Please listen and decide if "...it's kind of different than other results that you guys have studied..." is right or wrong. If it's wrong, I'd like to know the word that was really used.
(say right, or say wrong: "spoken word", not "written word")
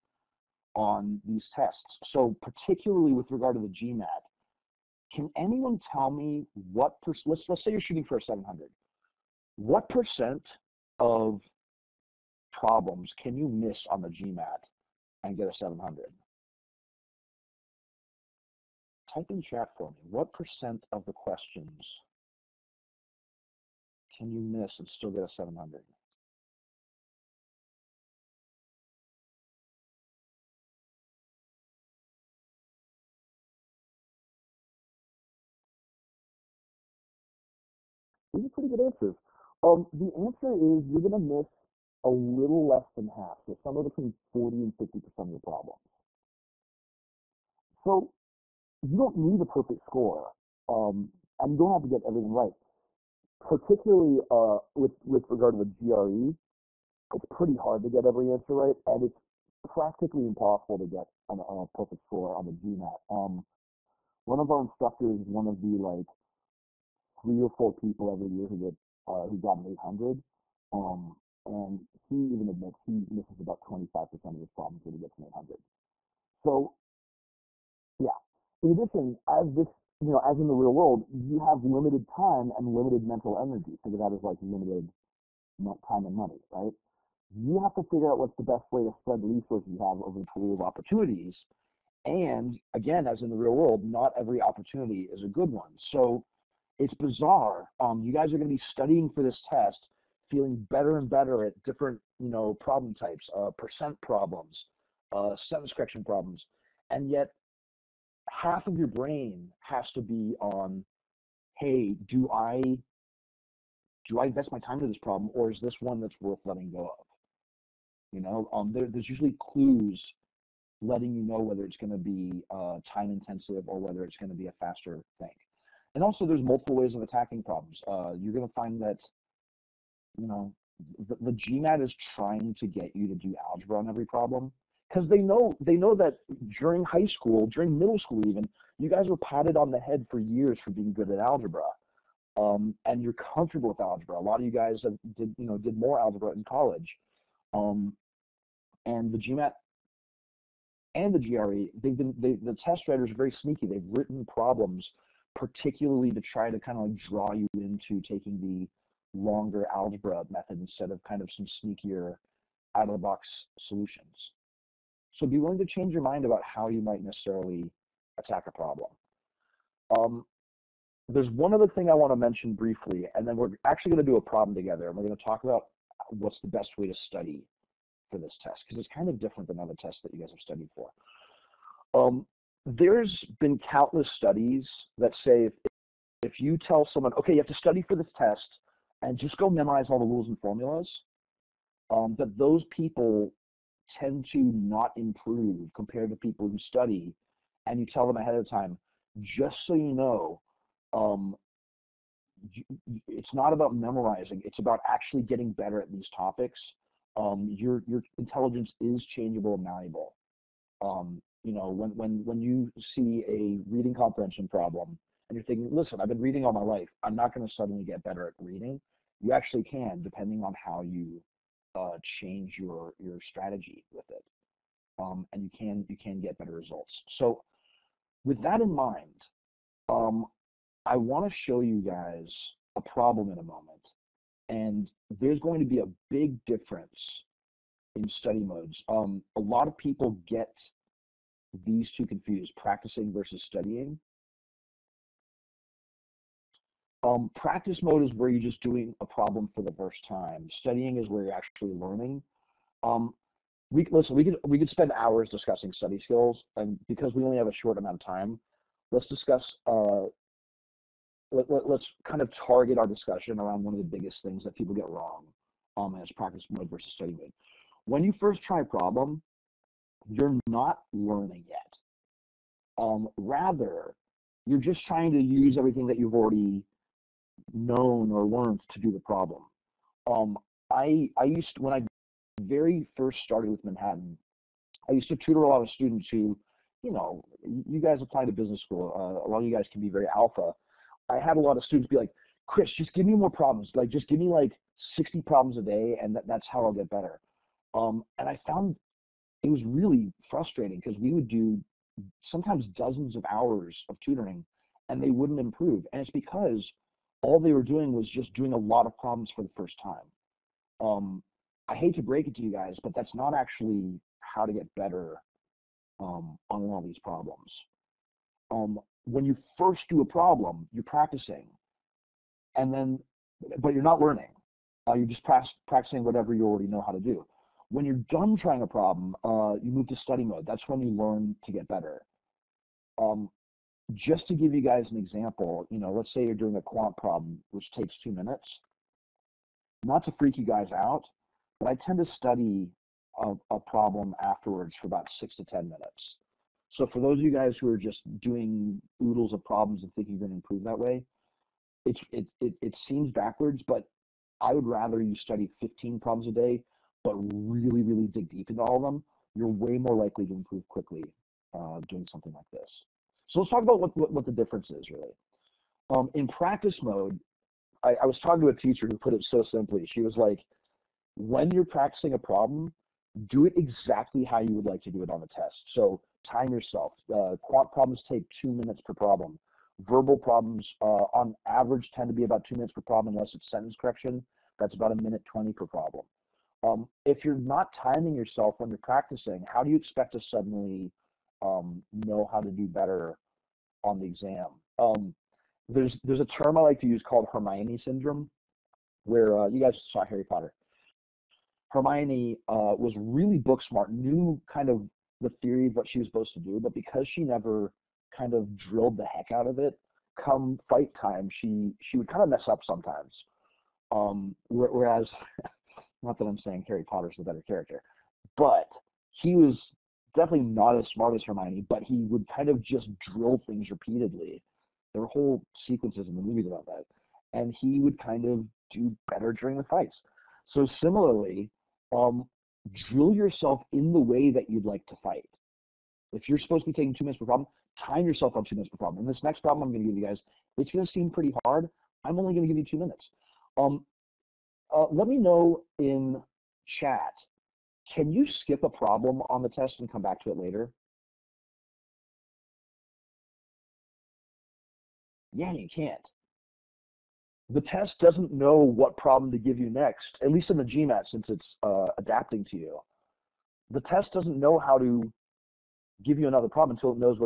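wrong: "tests", not "results".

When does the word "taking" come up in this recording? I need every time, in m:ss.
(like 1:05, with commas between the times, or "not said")
2:38, 7:16.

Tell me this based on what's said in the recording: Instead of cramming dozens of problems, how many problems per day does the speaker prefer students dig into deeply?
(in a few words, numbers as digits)
15.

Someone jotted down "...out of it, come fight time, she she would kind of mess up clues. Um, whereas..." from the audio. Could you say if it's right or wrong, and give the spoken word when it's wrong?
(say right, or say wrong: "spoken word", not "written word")
wrong: "sometimes", not "clues".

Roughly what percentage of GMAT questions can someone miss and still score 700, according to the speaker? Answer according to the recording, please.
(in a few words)
40 and 50%.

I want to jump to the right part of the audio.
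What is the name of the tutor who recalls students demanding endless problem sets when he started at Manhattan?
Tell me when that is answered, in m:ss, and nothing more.
4:52.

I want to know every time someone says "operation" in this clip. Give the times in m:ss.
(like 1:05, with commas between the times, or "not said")
not said.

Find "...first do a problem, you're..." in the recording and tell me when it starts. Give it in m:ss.
5:19.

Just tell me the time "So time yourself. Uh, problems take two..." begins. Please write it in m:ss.
6:15.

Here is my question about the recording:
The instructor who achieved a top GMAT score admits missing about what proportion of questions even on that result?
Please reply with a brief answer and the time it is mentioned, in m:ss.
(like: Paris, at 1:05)
25%, at 1:13.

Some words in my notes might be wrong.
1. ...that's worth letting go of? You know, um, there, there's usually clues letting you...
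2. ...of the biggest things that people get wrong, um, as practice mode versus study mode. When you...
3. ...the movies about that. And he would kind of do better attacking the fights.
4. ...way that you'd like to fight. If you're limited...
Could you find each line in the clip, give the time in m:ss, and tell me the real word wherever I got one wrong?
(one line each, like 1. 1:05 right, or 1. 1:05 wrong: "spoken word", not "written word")
1. 1:56 right
2. 4:23 right
3. 7:06 wrong: "during", not "attacking"
4. 7:14 wrong: "supposed", not "limited".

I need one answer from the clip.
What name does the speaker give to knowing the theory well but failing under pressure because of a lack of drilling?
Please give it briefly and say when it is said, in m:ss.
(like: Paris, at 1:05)
Hermione syndrome, at 6:37.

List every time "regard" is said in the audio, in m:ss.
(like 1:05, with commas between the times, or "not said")
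0:03, 0:55.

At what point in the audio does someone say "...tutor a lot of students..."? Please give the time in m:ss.
4:45.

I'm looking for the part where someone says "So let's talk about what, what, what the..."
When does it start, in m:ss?
6:03.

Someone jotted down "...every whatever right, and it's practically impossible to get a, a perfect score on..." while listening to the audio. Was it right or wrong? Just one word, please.
wrong.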